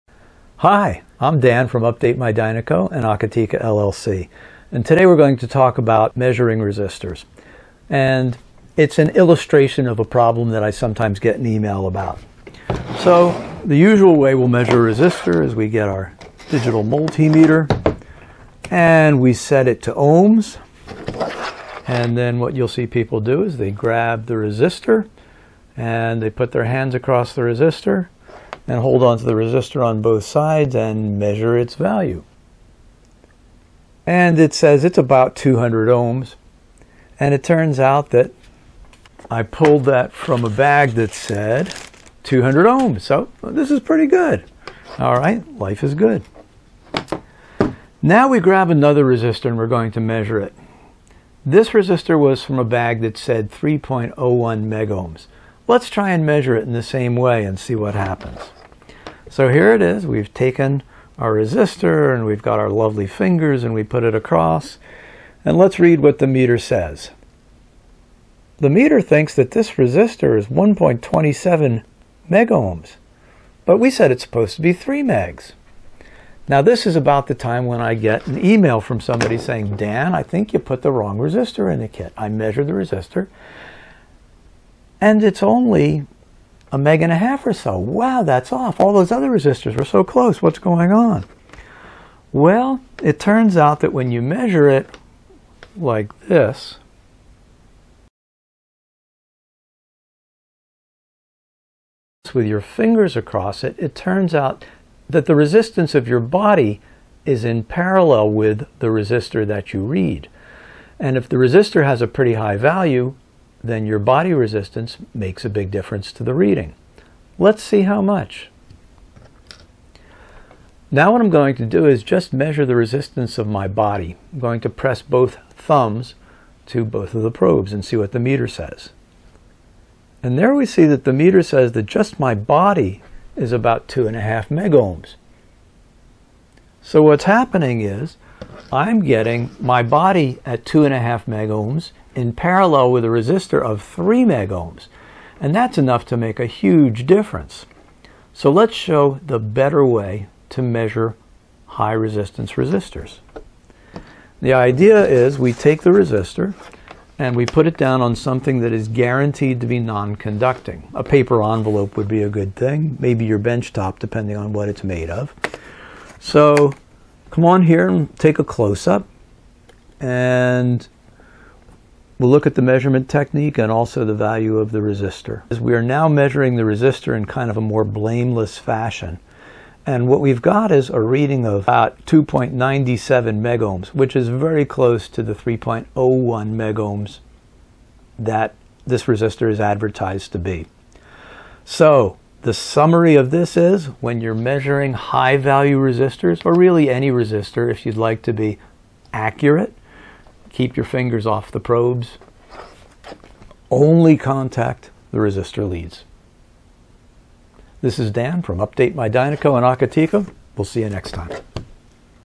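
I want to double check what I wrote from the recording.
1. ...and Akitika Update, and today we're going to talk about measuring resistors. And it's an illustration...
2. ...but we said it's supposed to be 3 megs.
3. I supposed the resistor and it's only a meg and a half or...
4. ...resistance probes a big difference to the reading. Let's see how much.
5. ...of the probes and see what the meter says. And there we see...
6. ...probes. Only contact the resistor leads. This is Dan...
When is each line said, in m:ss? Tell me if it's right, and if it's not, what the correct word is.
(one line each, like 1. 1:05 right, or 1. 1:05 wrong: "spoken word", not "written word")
1. 0:02 wrong: "LLC", not "Update"
2. 1:13 right
3. 1:22 wrong: "measured", not "supposed"
4. 1:54 wrong: "makes", not "probes"
5. 2:07 right
6. 3:21 right.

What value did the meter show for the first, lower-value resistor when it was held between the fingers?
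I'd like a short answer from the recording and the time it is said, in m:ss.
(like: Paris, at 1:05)
200 ohms, at 0:34.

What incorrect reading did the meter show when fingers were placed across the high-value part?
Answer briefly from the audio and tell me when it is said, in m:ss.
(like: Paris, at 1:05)
1.27 megohms, at 1:10.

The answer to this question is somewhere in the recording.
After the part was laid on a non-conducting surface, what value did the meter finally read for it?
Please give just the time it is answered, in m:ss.
3:02.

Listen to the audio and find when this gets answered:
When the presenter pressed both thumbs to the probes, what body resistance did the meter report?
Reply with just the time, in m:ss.
2:13.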